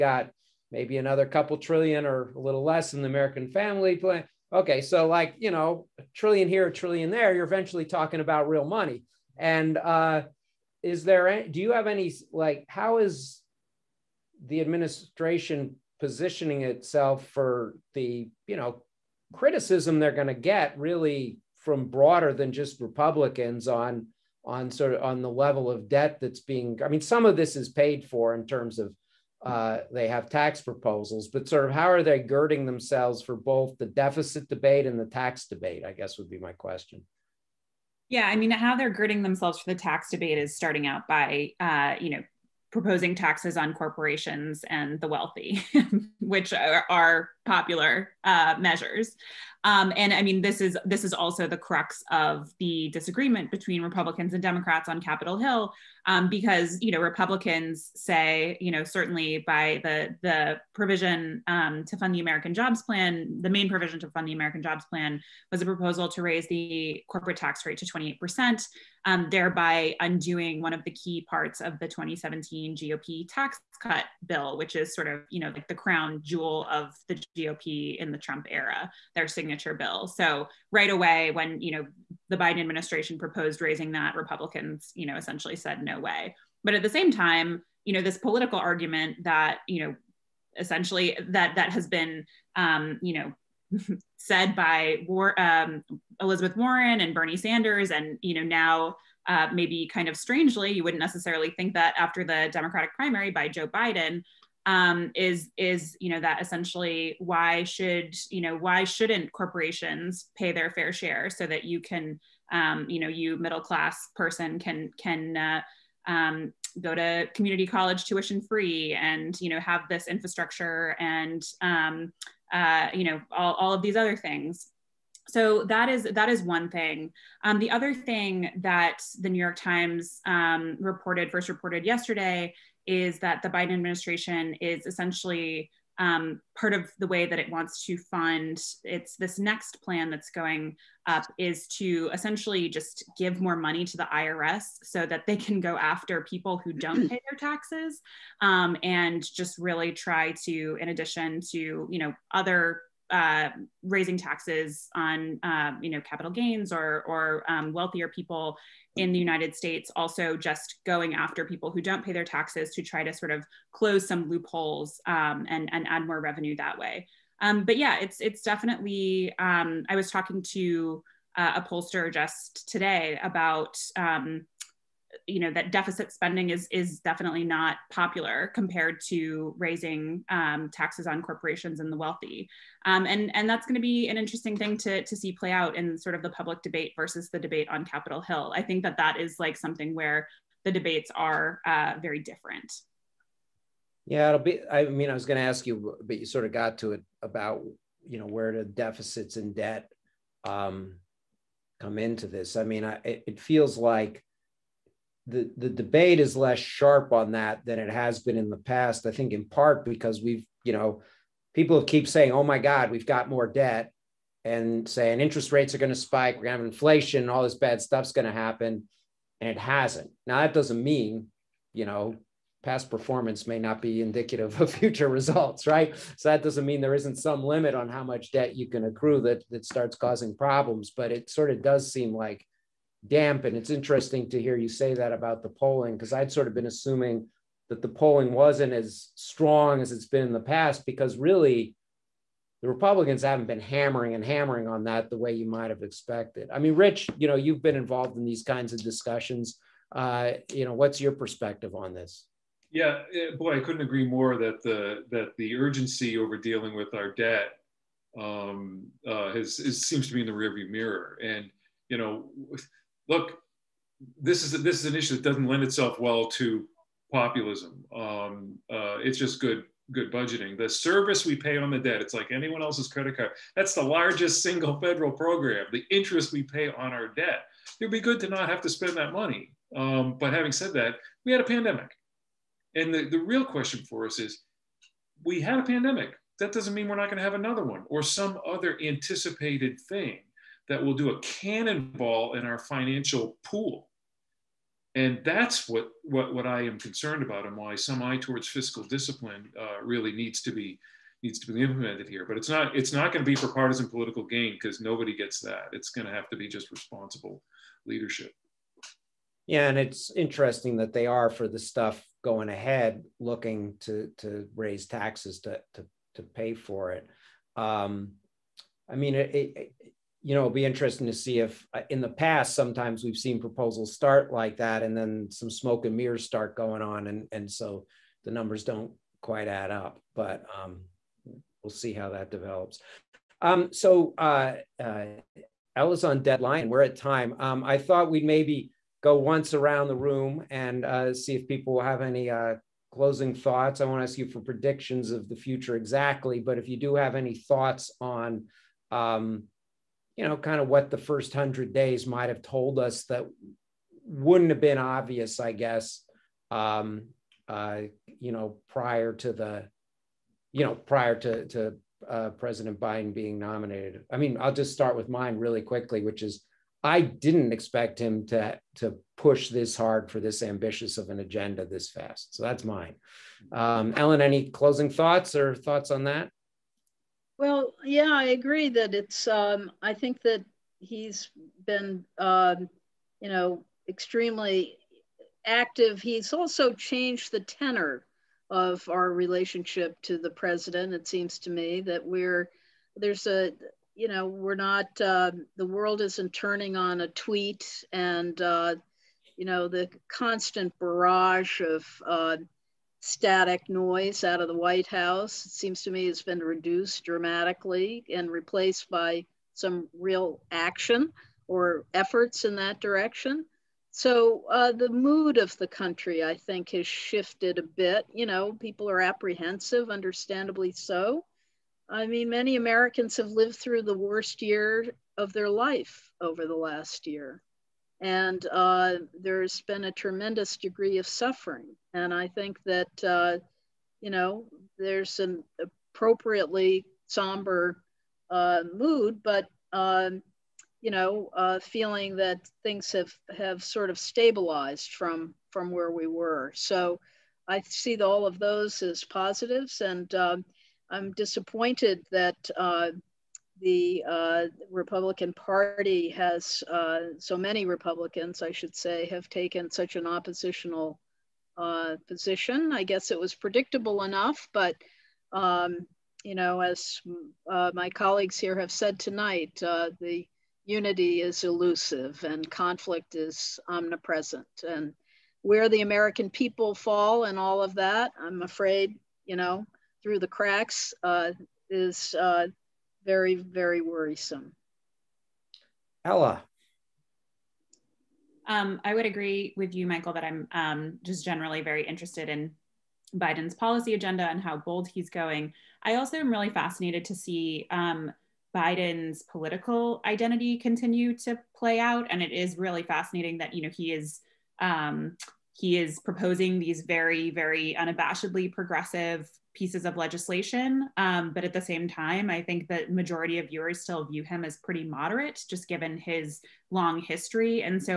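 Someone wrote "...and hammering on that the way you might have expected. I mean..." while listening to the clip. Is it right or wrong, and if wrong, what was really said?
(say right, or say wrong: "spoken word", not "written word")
right.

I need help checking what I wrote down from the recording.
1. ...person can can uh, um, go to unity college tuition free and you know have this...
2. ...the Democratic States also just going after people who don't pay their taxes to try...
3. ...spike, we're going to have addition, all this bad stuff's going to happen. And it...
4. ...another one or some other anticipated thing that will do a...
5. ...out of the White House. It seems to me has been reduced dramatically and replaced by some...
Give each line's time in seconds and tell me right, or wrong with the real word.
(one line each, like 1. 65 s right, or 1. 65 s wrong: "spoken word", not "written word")
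1. 114 s wrong: "community", not "unity"
2. 159 s wrong: "United", not "Democratic"
3. 215 s wrong: "inflation", not "addition"
4. 287 s right
5. 404 s right.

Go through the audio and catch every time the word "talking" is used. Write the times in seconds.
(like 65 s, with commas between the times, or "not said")
7 s, 170 s.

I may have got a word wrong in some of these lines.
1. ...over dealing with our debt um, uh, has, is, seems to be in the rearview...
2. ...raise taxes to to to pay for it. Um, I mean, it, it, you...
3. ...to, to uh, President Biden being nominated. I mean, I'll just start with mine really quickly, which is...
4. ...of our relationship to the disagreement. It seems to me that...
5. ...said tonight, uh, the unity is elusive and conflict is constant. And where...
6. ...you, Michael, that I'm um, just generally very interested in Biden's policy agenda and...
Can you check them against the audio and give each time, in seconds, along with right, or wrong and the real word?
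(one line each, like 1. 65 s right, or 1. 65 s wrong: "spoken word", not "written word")
1. 256 s right
2. 314 s right
3. 361 s right
4. 388 s wrong: "president", not "disagreement"
5. 468 s wrong: "omnipresent", not "constant"
6. 489 s right.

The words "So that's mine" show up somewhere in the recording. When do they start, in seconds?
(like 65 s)
372 s.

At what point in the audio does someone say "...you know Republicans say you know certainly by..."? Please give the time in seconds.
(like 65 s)
56 s.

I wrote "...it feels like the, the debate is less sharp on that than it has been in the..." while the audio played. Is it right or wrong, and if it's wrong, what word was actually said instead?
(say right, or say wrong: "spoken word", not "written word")
right.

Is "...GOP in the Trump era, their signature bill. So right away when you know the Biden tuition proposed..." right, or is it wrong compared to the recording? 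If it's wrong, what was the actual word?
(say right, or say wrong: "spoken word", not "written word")
wrong: "administration", not "tuition".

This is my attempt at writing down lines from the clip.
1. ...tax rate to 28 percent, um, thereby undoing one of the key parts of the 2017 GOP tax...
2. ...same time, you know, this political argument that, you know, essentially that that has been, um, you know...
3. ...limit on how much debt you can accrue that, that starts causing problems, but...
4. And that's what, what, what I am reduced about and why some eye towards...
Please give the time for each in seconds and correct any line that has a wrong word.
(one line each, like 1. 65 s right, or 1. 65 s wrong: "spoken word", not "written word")
1. 67 s right
2. 86 s right
3. 227 s right
4. 294 s wrong: "concerned", not "reduced".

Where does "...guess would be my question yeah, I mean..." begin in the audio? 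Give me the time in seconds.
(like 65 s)
35 s.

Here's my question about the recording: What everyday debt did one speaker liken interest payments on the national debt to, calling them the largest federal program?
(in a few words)
credit card.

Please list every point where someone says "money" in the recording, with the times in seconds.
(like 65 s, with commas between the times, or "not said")
8 s, 143 s, 279 s.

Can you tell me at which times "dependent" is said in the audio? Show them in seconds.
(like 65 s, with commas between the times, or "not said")
not said.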